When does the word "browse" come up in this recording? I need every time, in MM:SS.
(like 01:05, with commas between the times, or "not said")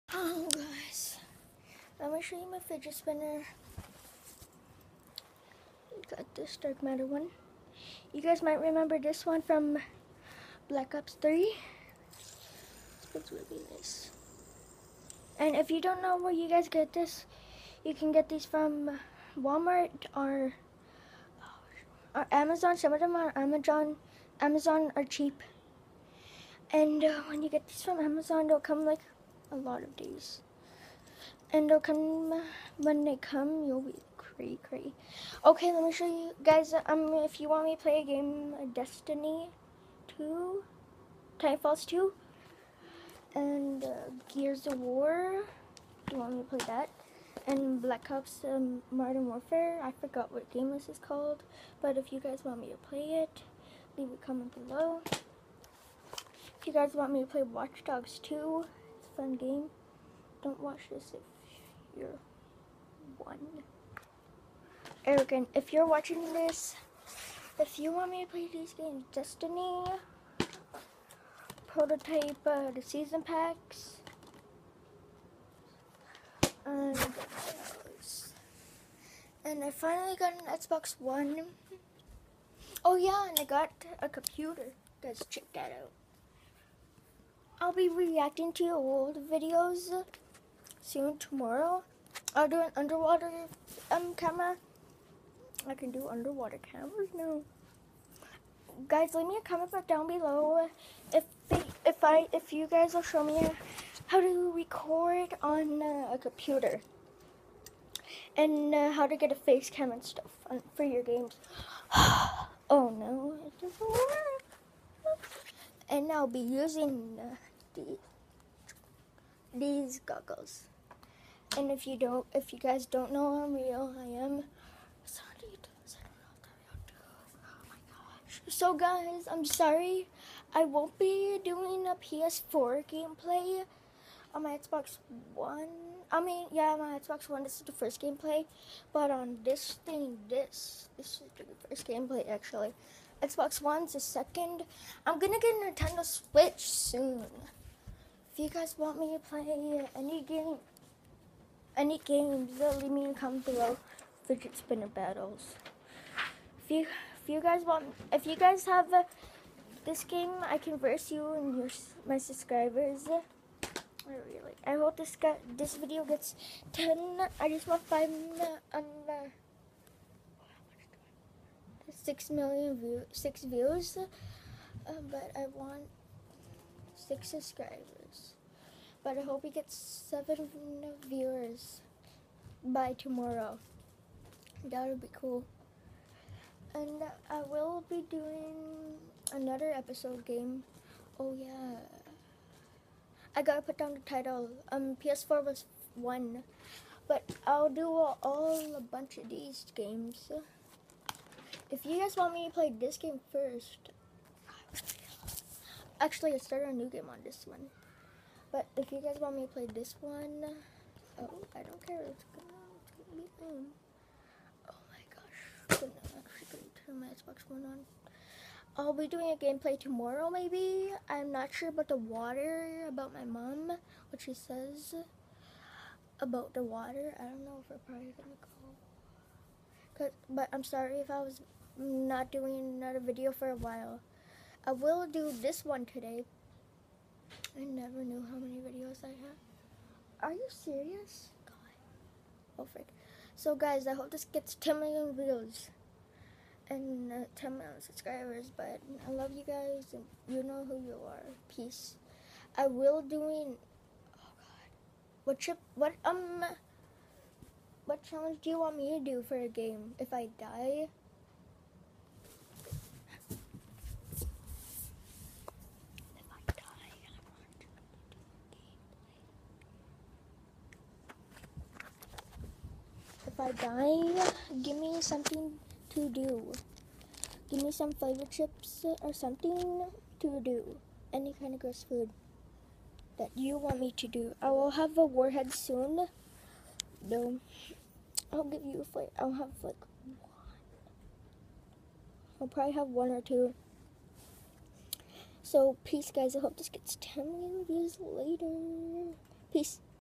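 not said.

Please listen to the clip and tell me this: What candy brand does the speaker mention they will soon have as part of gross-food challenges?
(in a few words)
Warhead.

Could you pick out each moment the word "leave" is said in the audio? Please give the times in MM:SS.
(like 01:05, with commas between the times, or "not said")
00:53, 01:39, 02:32.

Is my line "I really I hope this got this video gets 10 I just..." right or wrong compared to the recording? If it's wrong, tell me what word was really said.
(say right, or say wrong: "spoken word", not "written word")
right.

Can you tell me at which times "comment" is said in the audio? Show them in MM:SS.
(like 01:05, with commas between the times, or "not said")
00:54, 01:39, 02:33.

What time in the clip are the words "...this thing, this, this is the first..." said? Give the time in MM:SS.
02:19.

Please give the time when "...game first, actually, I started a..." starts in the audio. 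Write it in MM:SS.
03:22.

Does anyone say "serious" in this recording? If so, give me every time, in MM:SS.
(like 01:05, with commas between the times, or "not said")
04:00.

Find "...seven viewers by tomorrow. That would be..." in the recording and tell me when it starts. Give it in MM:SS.
02:59.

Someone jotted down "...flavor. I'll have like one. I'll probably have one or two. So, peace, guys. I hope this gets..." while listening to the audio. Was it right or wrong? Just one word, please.
right.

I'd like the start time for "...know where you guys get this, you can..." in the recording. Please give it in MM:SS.
00:16.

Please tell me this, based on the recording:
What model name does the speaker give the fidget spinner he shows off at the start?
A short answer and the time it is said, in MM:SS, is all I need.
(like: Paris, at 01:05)
Dark matter, at 00:06.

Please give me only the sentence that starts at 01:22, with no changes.
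Oh yeah, and I got a computer.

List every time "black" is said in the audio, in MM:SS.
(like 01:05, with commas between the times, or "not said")
00:10, 00:47.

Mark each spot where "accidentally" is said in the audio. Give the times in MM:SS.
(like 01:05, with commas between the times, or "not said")
not said.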